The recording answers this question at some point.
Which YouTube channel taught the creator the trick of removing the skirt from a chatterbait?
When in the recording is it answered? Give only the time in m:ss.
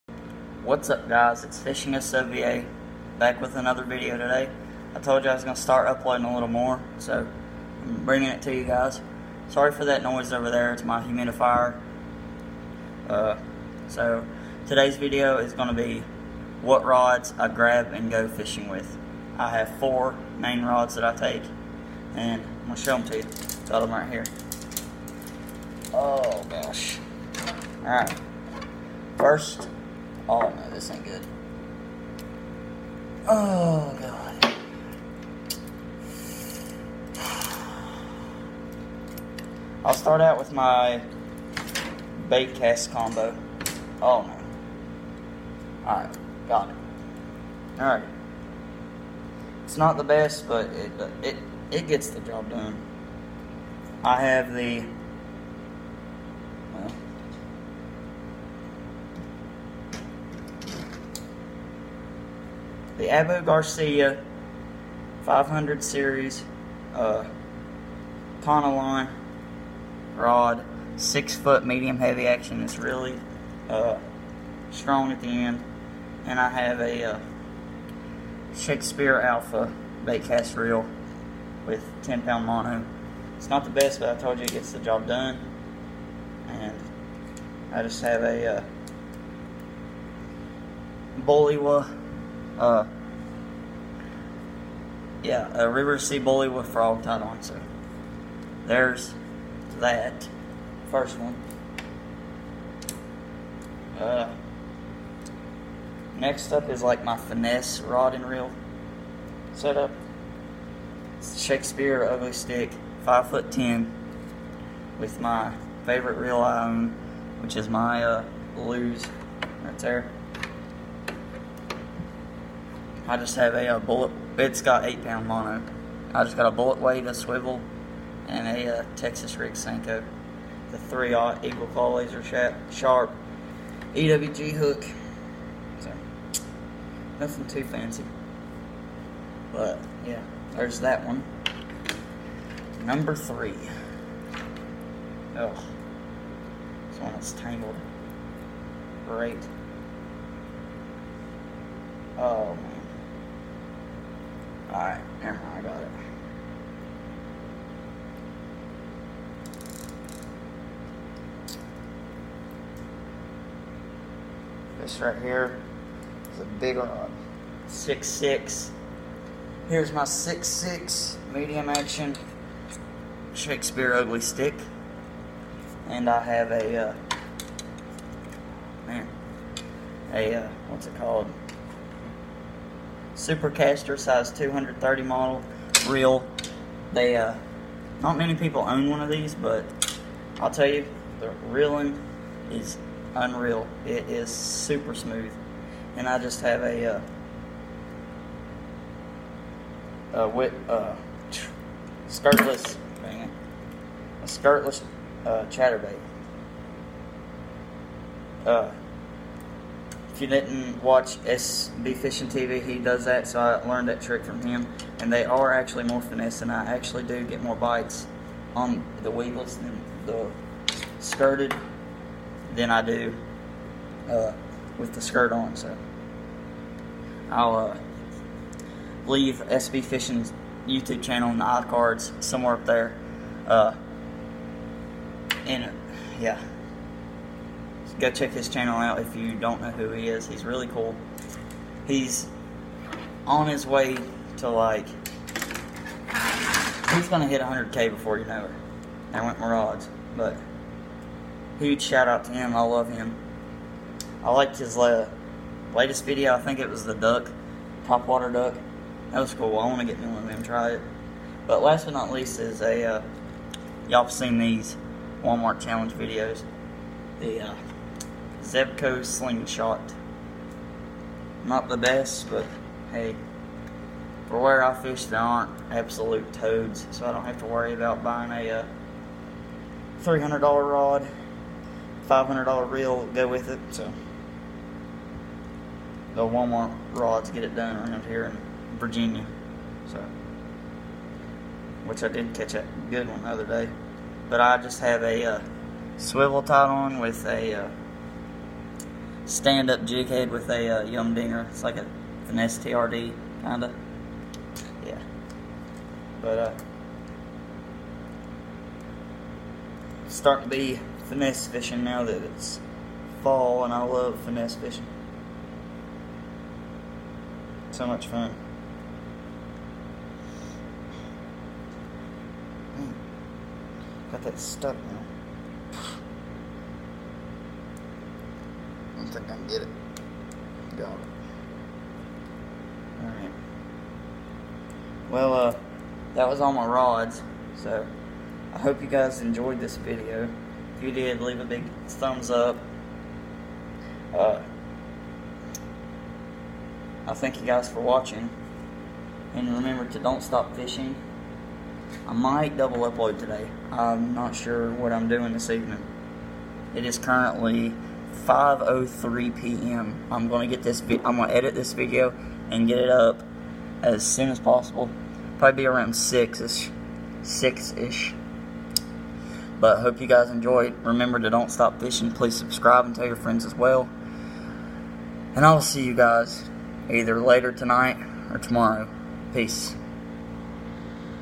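3:31.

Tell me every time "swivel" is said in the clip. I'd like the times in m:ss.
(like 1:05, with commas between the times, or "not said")
2:07, 4:55.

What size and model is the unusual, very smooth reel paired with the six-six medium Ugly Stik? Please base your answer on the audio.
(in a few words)
Supercaster size 230.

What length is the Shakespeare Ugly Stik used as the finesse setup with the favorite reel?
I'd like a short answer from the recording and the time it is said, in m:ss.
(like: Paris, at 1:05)
5 foot 10, at 1:53.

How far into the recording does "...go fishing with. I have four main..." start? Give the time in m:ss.
0:18.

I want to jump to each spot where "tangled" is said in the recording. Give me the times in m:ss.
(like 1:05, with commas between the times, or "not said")
2:27.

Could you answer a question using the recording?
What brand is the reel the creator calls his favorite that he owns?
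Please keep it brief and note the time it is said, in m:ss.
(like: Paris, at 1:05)
Lew's, at 1:58.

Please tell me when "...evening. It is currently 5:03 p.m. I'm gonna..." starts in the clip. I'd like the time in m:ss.
5:55.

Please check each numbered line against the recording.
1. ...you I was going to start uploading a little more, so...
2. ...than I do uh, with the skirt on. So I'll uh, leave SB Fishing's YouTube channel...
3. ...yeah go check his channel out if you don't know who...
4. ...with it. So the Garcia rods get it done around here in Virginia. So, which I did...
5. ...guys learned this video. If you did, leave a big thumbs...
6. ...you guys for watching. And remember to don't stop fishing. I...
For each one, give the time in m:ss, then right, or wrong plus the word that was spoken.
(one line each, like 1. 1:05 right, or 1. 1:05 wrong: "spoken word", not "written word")
1. 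0:05 right
2. 3:42 right
3. 3:56 right
4. 4:43 wrong: "Walmart", not "Garcia"
5. 5:38 wrong: "enjoyed", not "learned"
6. 5:47 right.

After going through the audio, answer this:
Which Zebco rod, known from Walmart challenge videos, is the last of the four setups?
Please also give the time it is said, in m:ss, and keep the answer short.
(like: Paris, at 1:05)
Zebco Slingshot, at 4:28.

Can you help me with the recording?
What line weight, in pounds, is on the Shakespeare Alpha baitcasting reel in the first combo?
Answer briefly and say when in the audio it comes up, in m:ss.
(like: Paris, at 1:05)
10 pound, at 1:22.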